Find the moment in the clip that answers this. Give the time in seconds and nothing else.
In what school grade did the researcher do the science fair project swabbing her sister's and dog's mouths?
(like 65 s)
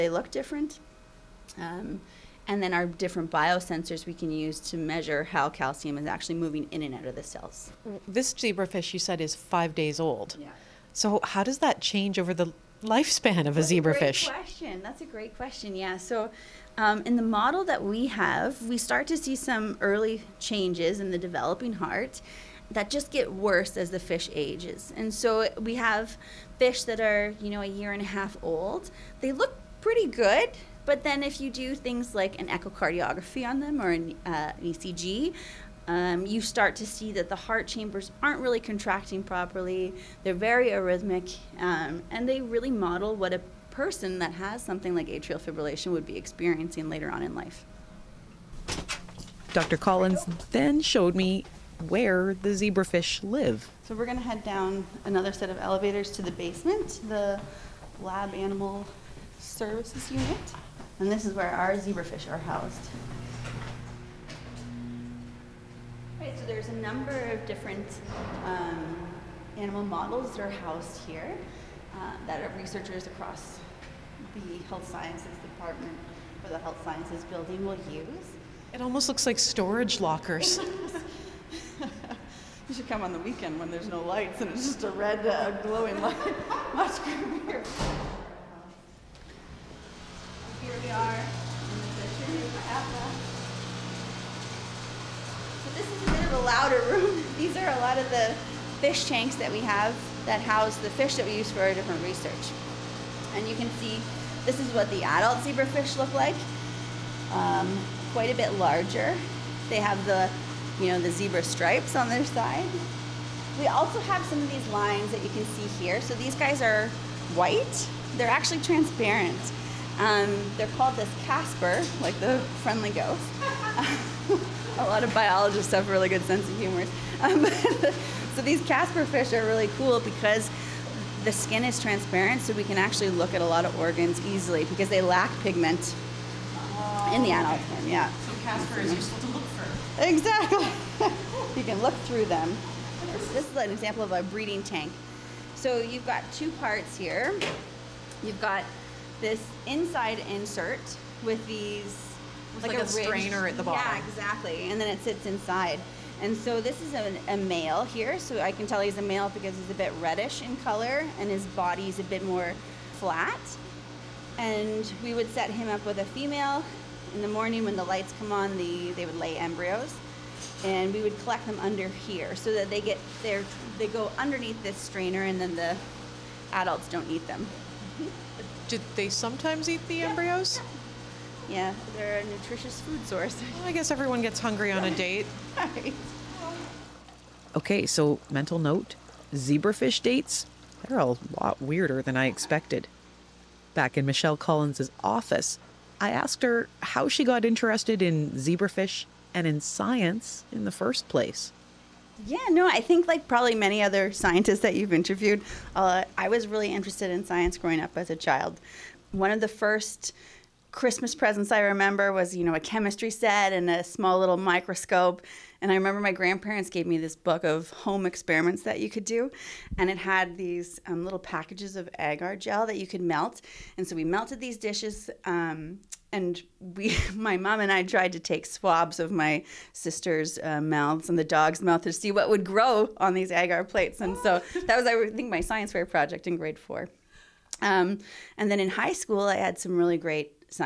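236 s.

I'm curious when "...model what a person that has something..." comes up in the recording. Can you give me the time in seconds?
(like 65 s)
42 s.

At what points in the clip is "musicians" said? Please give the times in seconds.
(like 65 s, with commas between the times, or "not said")
not said.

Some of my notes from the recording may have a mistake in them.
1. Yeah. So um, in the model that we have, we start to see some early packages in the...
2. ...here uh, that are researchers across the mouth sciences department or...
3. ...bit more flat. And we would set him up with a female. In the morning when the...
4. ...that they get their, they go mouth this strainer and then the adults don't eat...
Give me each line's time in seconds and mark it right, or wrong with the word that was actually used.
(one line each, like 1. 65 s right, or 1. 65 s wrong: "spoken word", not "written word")
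1. 15 s wrong: "changes", not "packages"
2. 71 s wrong: "health", not "mouth"
3. 162 s right
4. 172 s wrong: "underneath", not "mouth".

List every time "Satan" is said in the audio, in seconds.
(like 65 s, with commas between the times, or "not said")
not said.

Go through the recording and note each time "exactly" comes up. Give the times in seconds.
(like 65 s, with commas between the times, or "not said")
140 s, 154 s.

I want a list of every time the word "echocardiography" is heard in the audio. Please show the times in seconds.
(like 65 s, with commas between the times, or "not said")
32 s.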